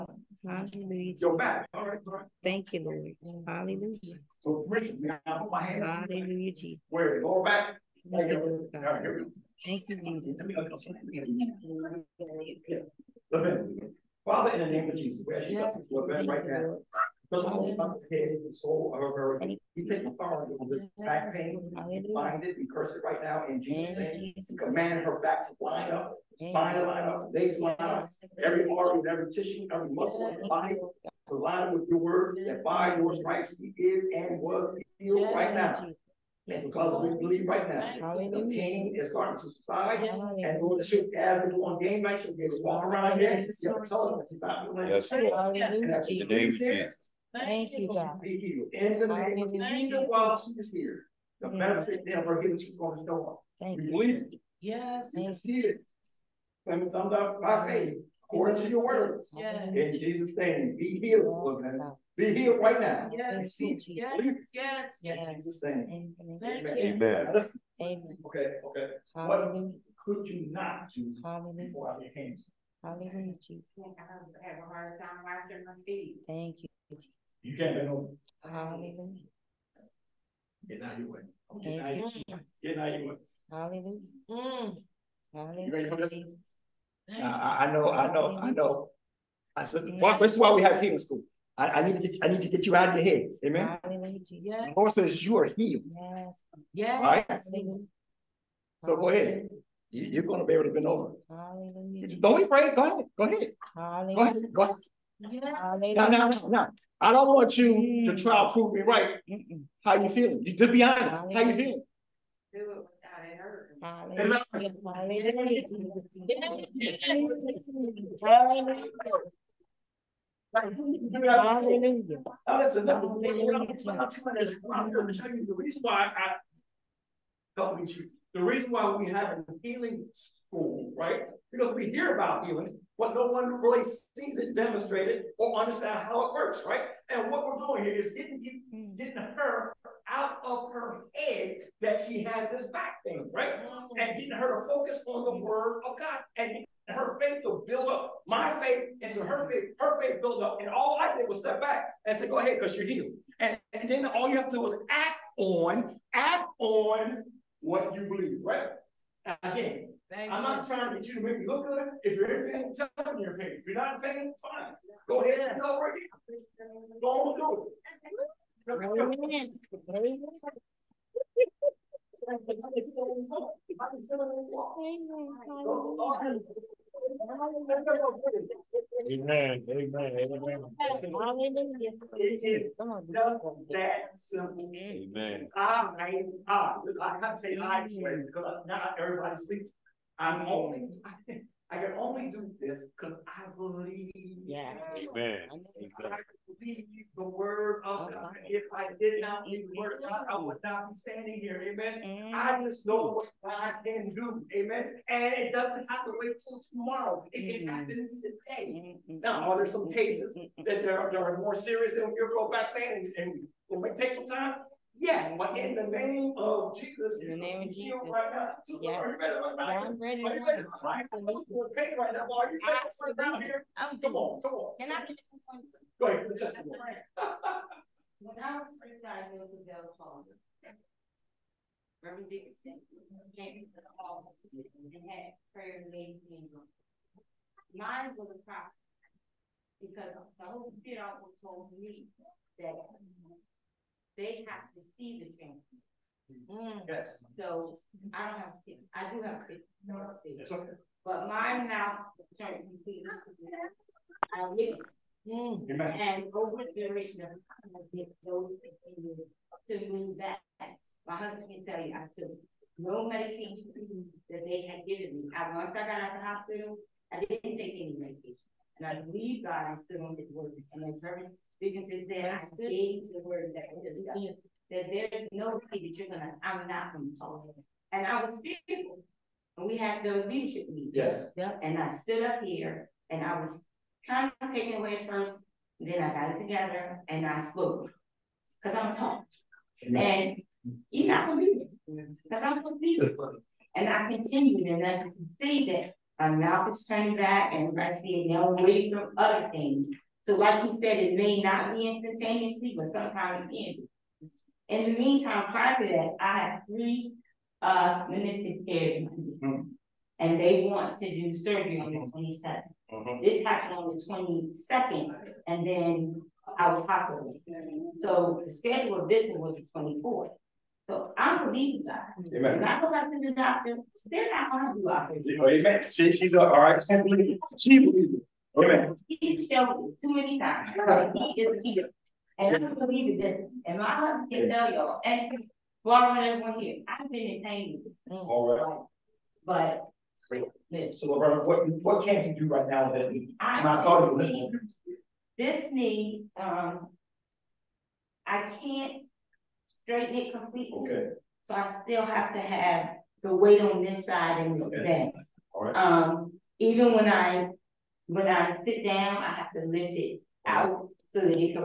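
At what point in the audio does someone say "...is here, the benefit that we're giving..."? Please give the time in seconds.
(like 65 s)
50 s.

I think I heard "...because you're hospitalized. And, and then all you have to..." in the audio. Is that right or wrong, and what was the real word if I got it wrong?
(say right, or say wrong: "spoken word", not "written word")
wrong: "healed", not "hospitalized".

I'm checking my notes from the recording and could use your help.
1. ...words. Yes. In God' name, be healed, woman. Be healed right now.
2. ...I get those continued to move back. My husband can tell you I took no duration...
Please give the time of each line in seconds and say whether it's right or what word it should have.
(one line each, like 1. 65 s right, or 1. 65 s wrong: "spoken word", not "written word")
1. 58 s wrong: "Jesus", not "God"
2. 257 s wrong: "medication", not "duration".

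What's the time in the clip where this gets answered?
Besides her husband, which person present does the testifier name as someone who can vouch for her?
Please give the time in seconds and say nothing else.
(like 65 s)
335 s.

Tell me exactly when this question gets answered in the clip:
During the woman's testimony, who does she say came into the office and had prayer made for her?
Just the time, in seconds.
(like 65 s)
232 s.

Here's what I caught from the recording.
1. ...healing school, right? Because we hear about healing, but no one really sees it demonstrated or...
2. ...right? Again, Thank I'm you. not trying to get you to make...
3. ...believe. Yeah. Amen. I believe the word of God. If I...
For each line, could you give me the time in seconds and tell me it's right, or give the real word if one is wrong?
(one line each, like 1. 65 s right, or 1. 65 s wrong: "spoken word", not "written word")
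1. 129 s right
2. 158 s right
3. 193 s right.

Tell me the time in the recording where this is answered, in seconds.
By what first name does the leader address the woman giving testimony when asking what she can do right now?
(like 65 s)
341 s.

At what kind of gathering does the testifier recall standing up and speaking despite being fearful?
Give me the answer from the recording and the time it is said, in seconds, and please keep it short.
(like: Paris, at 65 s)
Leadership meeting, at 280 s.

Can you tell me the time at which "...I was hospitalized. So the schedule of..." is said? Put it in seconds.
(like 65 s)
316 s.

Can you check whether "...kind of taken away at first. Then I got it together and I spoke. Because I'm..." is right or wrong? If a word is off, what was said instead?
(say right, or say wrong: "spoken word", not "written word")
right.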